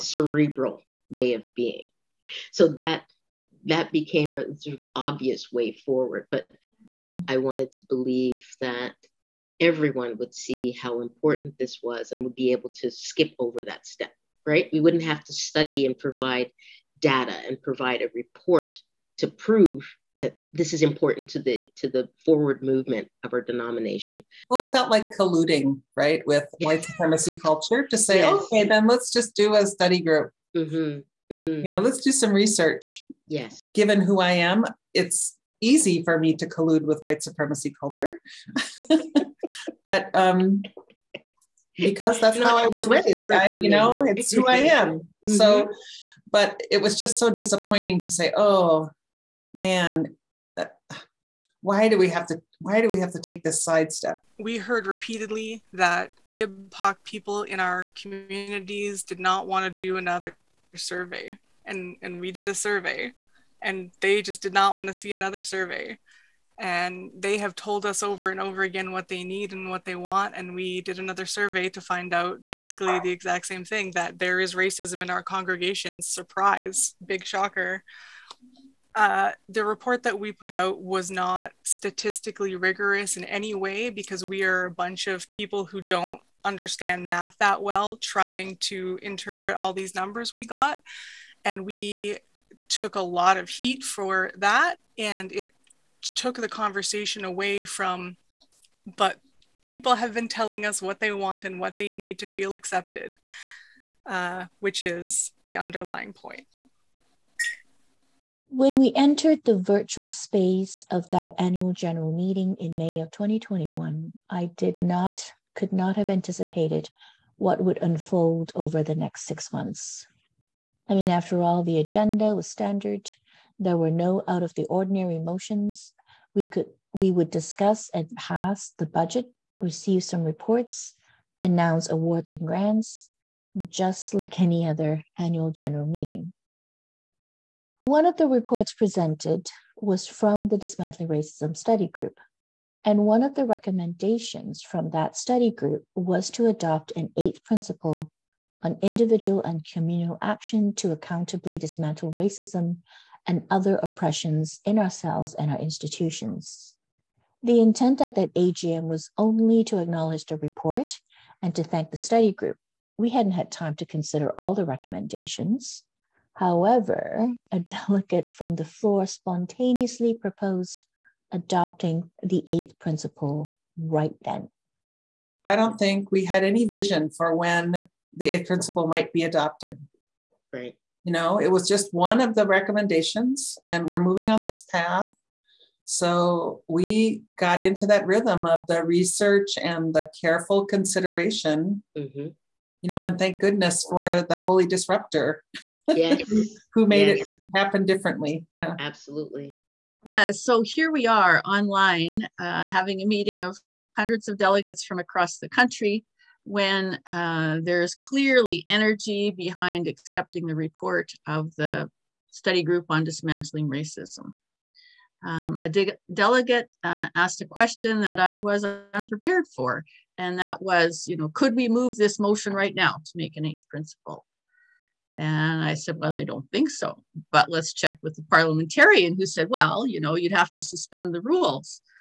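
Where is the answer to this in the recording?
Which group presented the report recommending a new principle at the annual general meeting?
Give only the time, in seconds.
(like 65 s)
140 s.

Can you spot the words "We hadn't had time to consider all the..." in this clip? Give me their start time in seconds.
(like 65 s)
162 s.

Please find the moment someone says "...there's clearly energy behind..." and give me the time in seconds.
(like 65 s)
207 s.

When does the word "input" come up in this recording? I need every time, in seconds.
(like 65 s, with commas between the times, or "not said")
not said.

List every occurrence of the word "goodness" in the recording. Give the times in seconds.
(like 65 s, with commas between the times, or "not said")
193 s.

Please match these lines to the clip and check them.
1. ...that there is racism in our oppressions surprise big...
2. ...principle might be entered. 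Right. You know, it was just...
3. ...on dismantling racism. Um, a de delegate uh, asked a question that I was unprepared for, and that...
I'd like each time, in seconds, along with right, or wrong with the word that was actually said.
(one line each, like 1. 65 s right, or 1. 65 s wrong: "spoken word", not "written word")
1. 73 s wrong: "congregations", not "oppressions"
2. 178 s wrong: "adopted", not "entered"
3. 212 s right.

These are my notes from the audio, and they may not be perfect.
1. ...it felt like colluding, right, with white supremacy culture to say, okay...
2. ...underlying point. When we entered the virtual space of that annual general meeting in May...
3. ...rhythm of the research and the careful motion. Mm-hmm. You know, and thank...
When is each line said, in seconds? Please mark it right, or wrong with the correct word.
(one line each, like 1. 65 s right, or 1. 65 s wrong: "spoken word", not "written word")
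1. 24 s right
2. 105 s right
3. 188 s wrong: "consideration", not "motion".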